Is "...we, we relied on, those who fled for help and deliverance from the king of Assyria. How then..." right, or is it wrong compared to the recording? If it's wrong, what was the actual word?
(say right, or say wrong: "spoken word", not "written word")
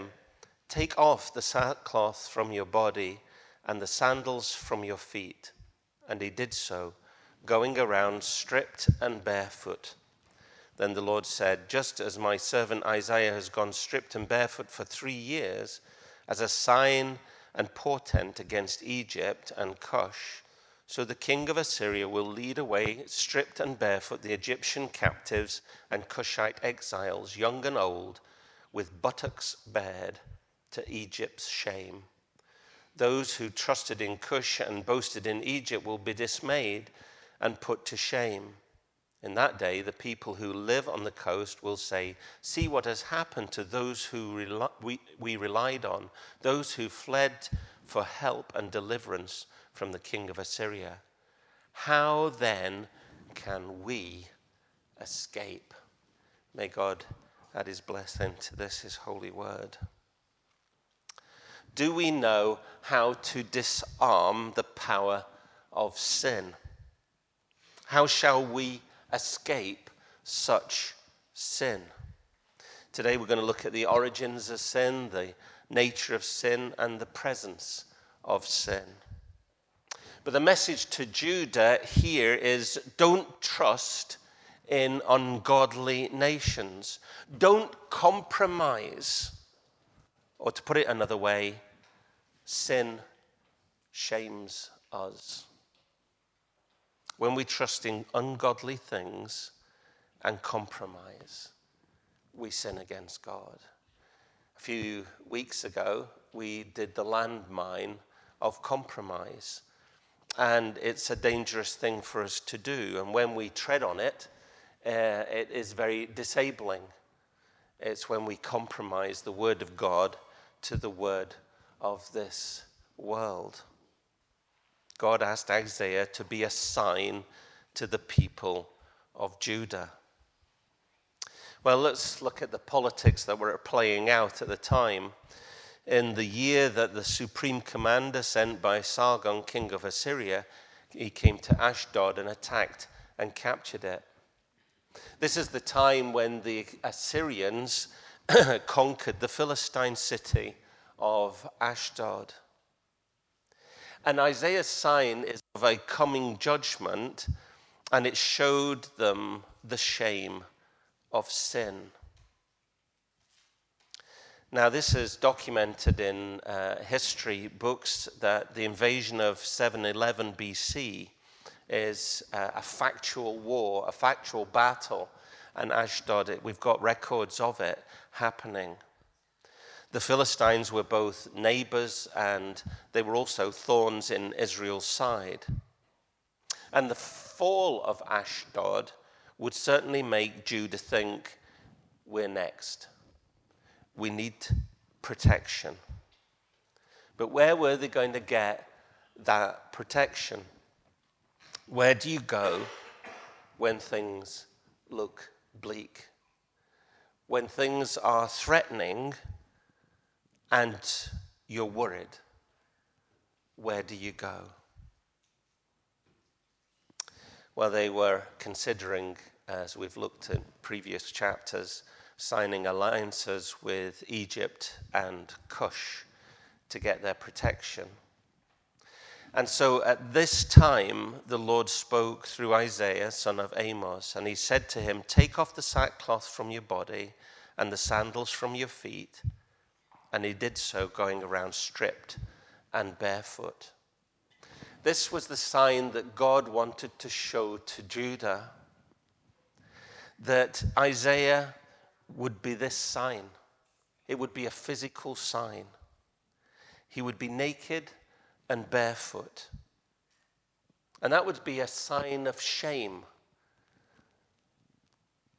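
right.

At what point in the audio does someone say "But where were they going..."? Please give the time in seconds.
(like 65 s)
197 s.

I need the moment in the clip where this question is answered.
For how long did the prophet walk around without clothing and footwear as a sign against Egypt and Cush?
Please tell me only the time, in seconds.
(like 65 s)
14 s.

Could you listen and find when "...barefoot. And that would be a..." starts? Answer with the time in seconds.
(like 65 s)
258 s.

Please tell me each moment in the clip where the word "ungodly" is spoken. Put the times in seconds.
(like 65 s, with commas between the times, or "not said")
85 s, 98 s.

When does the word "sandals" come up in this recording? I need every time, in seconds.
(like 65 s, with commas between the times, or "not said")
3 s, 237 s.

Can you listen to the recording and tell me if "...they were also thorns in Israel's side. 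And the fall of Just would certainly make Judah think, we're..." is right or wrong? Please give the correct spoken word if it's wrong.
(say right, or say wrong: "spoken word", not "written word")
wrong: "Ashdod", not "Just".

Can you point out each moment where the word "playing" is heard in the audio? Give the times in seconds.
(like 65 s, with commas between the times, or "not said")
133 s.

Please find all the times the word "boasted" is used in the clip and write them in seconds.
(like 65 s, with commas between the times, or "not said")
34 s.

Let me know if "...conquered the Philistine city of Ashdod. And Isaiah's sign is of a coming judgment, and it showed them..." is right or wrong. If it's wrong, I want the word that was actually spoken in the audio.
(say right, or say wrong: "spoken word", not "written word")
right.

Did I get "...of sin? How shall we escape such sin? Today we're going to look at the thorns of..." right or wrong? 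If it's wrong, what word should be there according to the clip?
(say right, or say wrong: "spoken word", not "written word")
wrong: "origins", not "thorns".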